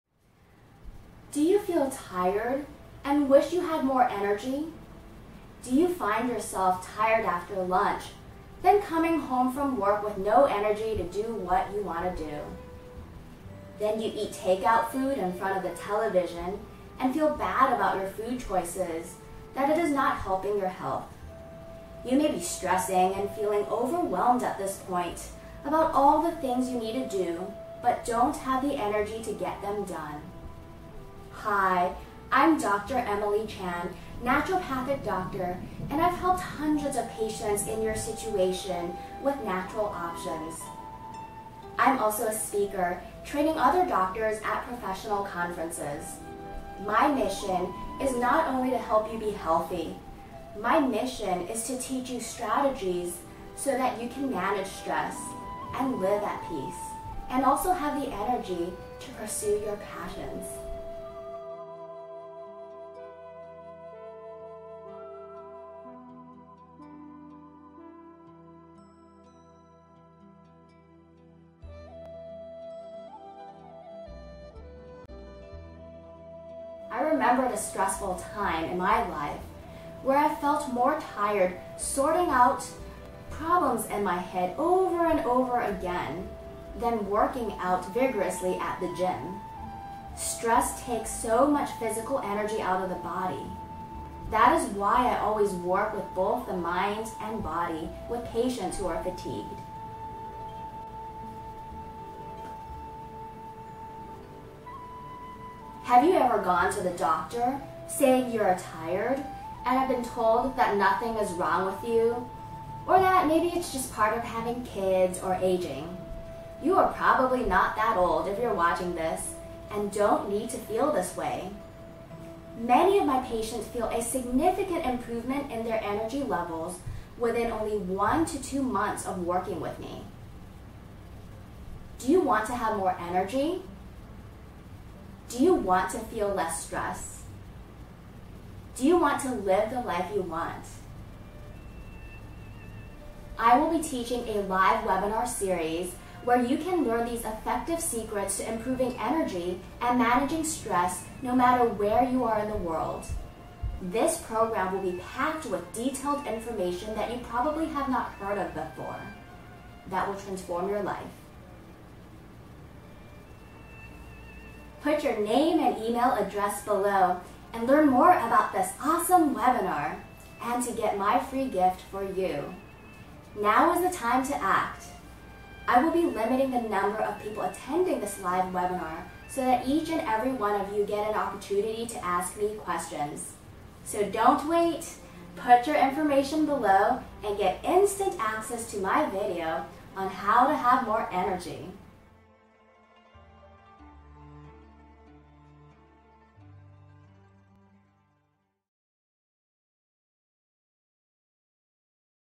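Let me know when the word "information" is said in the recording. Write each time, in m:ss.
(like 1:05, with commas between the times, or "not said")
2:36, 3:05.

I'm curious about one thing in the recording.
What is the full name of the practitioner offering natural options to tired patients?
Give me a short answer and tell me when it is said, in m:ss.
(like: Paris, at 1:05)
Emily Chan, at 0:32.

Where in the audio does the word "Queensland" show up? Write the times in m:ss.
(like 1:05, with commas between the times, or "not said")
not said.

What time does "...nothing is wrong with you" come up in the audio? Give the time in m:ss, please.
1:50.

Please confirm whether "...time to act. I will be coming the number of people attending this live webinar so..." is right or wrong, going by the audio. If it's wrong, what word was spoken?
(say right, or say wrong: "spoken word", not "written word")
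wrong: "limiting", not "coming".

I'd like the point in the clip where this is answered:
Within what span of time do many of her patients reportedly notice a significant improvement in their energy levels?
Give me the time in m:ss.
2:07.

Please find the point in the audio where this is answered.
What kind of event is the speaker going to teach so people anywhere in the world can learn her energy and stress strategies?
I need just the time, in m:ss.
2:24.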